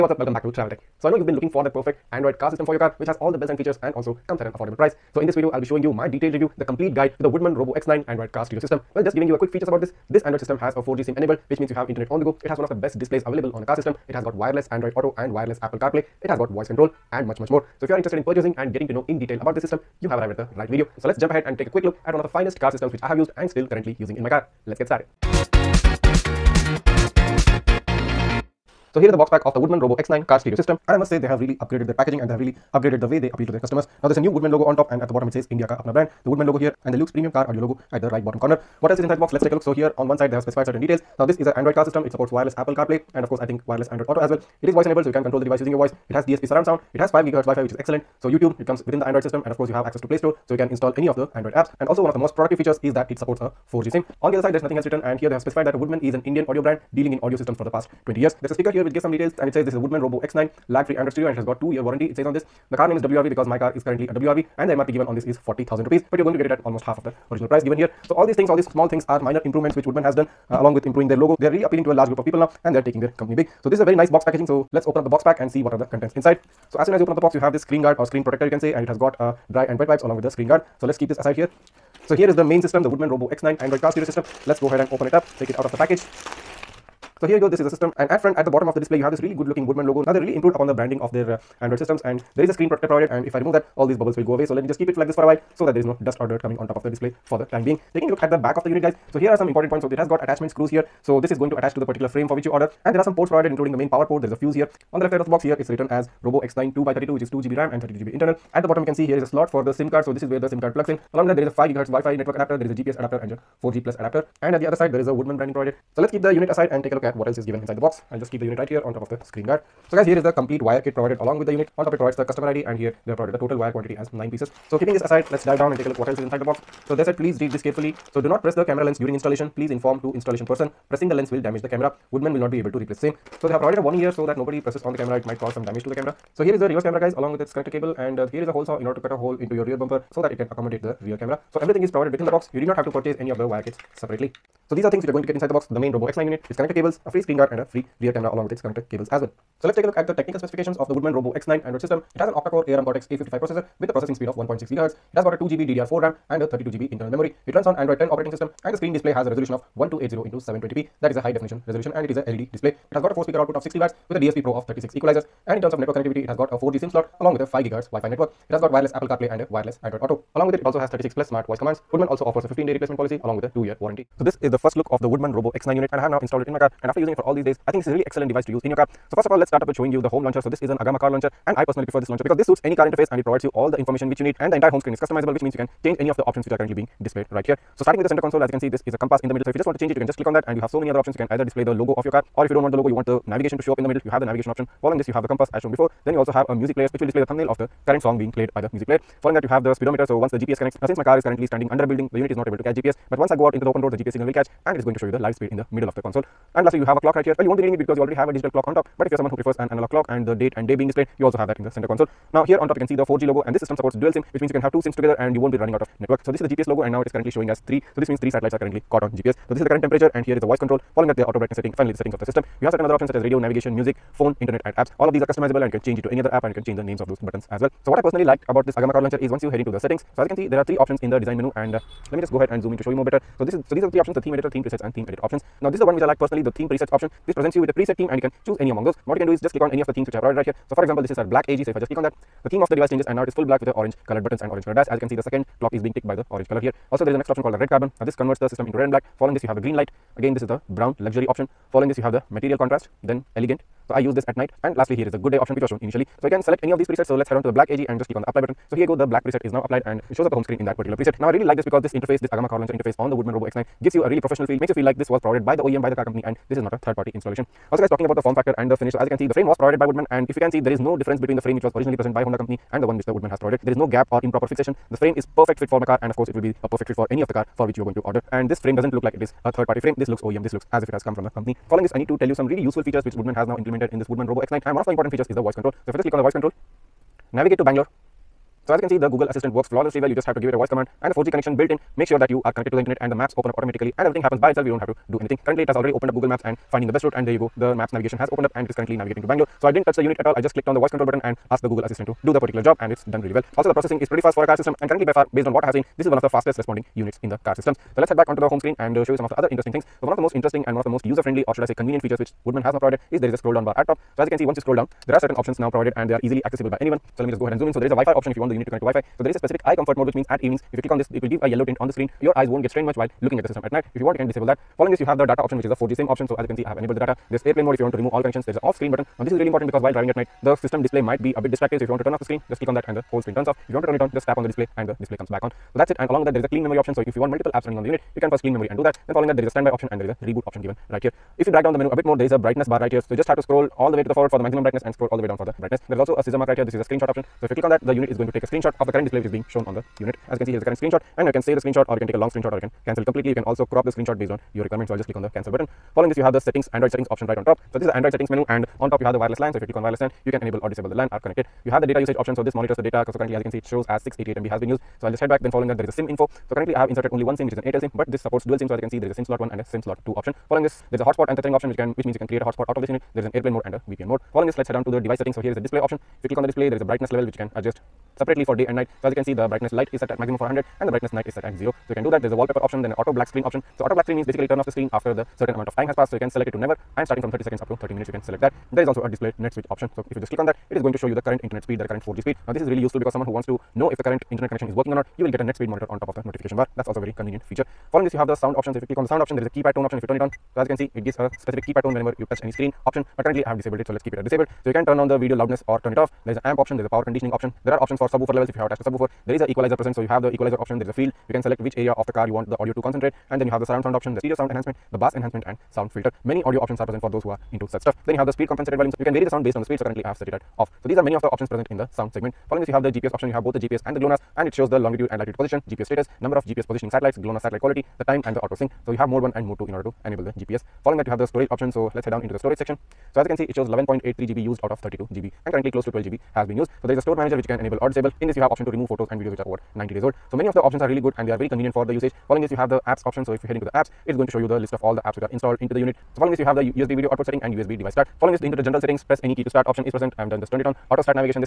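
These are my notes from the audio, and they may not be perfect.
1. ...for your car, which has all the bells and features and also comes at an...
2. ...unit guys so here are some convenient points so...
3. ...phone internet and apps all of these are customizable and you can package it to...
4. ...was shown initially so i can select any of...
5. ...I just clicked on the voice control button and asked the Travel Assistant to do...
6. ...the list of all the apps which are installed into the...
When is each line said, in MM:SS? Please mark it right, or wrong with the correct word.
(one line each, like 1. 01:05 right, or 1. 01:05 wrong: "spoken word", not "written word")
1. 00:02 right
2. 01:38 wrong: "important", not "convenient"
3. 03:44 wrong: "change", not "package"
4. 04:15 right
5. 05:00 wrong: "Google", not "Travel"
6. 07:24 right.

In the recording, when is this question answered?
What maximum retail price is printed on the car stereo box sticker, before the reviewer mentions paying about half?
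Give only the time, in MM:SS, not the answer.
01:05.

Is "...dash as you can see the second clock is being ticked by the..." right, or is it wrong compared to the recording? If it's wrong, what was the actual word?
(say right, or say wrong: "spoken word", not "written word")
right.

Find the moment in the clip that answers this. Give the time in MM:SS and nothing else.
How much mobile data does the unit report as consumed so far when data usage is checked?
06:04.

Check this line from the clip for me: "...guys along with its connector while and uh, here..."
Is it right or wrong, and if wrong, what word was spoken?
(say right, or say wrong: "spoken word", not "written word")
wrong: "cable", not "while".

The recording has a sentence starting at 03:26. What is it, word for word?
And lastly you have a clock right here.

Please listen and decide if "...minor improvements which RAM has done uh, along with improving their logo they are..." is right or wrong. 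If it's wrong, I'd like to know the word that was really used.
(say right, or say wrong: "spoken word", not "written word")
wrong: "Woodman", not "RAM".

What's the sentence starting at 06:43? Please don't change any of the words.
But currently I have disabled it.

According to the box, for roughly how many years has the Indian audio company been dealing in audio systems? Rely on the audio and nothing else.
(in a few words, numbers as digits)
20 years.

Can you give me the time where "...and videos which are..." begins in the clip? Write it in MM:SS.
07:19.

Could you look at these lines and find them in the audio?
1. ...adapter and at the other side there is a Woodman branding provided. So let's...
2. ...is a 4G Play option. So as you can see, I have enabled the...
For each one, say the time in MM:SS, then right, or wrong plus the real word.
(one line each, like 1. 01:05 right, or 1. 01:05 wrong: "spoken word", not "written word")
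1. 01:53 right
2. 05:25 wrong: "SIM", not "Play".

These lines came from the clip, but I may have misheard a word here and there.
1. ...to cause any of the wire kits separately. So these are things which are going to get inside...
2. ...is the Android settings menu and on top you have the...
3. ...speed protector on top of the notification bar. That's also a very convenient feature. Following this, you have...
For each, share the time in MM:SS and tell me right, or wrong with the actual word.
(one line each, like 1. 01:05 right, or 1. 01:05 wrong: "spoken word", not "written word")
1. 02:22 wrong: "purchase", not "cause"
2. 05:57 right
3. 06:35 wrong: "monitor", not "protector".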